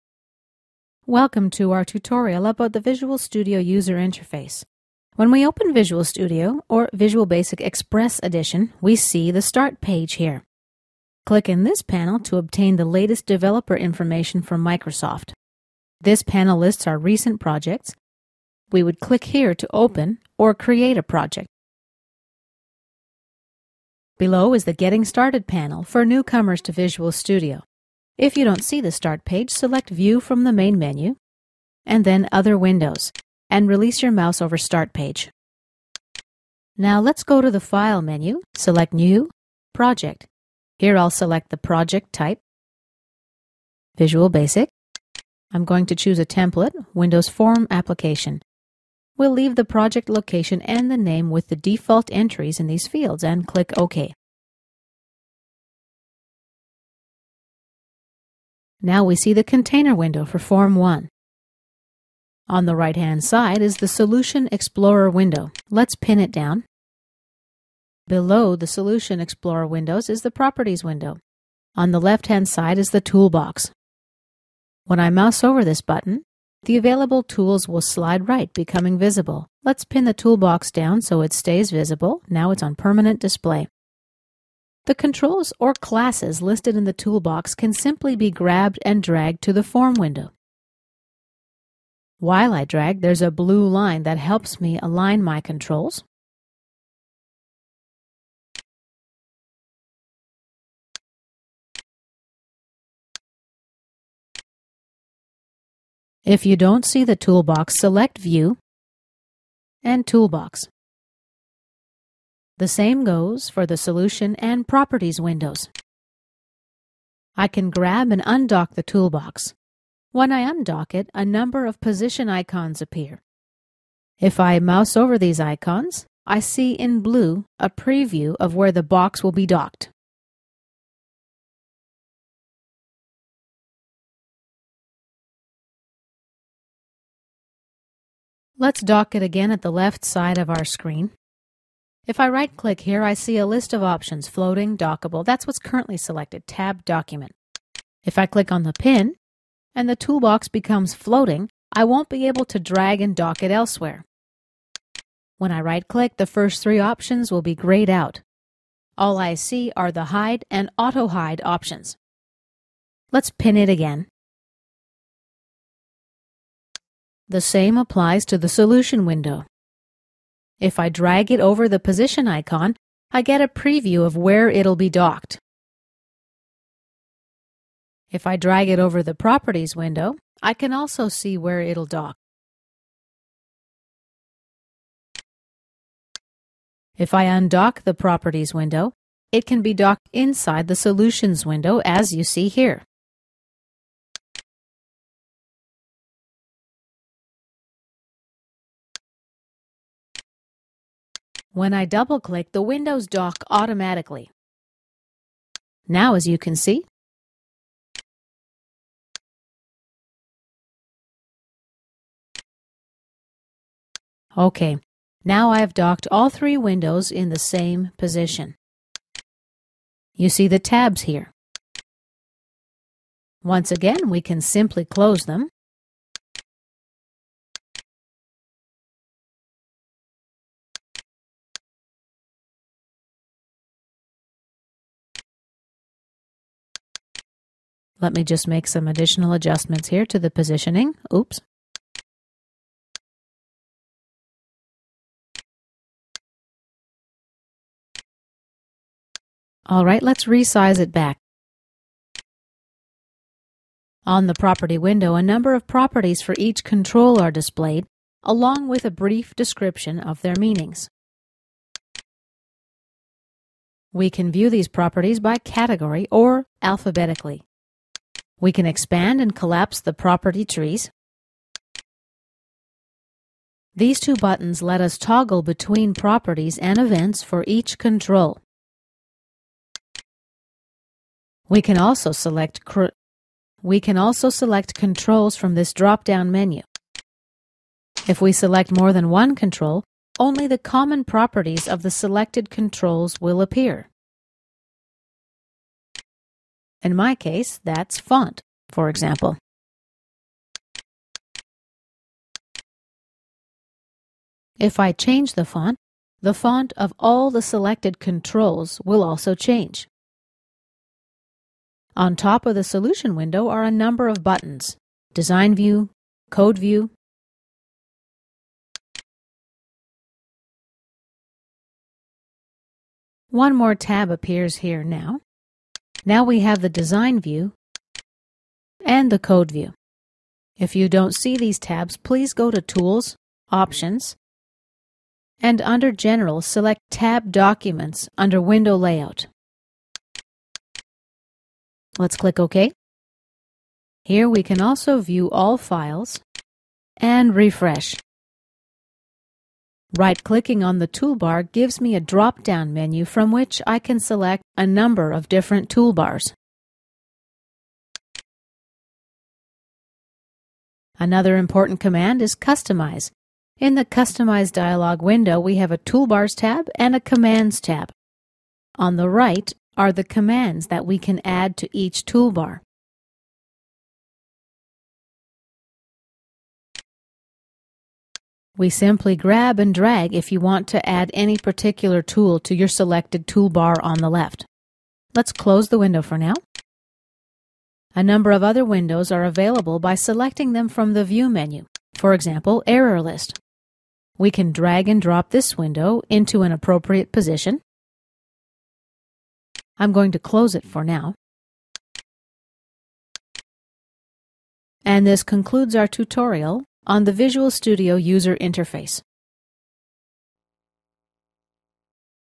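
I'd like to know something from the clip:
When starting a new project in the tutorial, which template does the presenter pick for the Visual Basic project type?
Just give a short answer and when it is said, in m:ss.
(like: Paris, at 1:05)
Windows Form application, at 0:46.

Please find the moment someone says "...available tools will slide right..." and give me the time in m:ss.
1:16.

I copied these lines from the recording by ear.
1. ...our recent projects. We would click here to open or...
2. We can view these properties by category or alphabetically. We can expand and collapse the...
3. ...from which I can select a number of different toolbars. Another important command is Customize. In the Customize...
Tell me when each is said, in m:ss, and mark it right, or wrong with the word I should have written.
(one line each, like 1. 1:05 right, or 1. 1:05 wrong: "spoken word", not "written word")
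1. 0:16 right
2. 4:23 right
3. 5:53 right.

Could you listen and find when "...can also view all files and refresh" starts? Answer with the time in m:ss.
5:44.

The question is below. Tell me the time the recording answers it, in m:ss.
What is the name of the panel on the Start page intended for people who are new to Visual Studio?
0:24.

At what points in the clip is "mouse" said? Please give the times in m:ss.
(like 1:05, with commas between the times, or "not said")
0:34, 1:15, 2:04.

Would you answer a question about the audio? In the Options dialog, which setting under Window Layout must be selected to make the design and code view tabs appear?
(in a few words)
Tab Documents.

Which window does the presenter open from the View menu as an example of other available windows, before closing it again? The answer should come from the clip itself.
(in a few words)
Error List.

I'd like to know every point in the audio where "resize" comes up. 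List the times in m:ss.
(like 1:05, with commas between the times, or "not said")
4:10.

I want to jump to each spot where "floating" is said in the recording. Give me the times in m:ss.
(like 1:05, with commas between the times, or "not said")
2:24, 2:30.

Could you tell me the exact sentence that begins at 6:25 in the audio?
Let's close the window for now.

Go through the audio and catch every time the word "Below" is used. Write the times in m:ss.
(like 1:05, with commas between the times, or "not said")
0:24, 1:08.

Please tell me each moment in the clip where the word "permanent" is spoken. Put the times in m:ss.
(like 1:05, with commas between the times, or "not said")
1:22.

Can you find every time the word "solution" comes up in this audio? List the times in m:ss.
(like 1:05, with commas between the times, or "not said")
1:03, 1:08, 1:53, 2:48, 3:10, 5:12.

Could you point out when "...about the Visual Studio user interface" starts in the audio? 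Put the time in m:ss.
0:02.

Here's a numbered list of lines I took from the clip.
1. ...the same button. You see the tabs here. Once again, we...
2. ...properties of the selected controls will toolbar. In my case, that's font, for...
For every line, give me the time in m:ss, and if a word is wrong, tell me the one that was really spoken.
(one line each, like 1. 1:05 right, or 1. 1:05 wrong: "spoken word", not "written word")
1. 3:37 wrong: "position", not "button"
2. 4:51 wrong: "appear", not "toolbar".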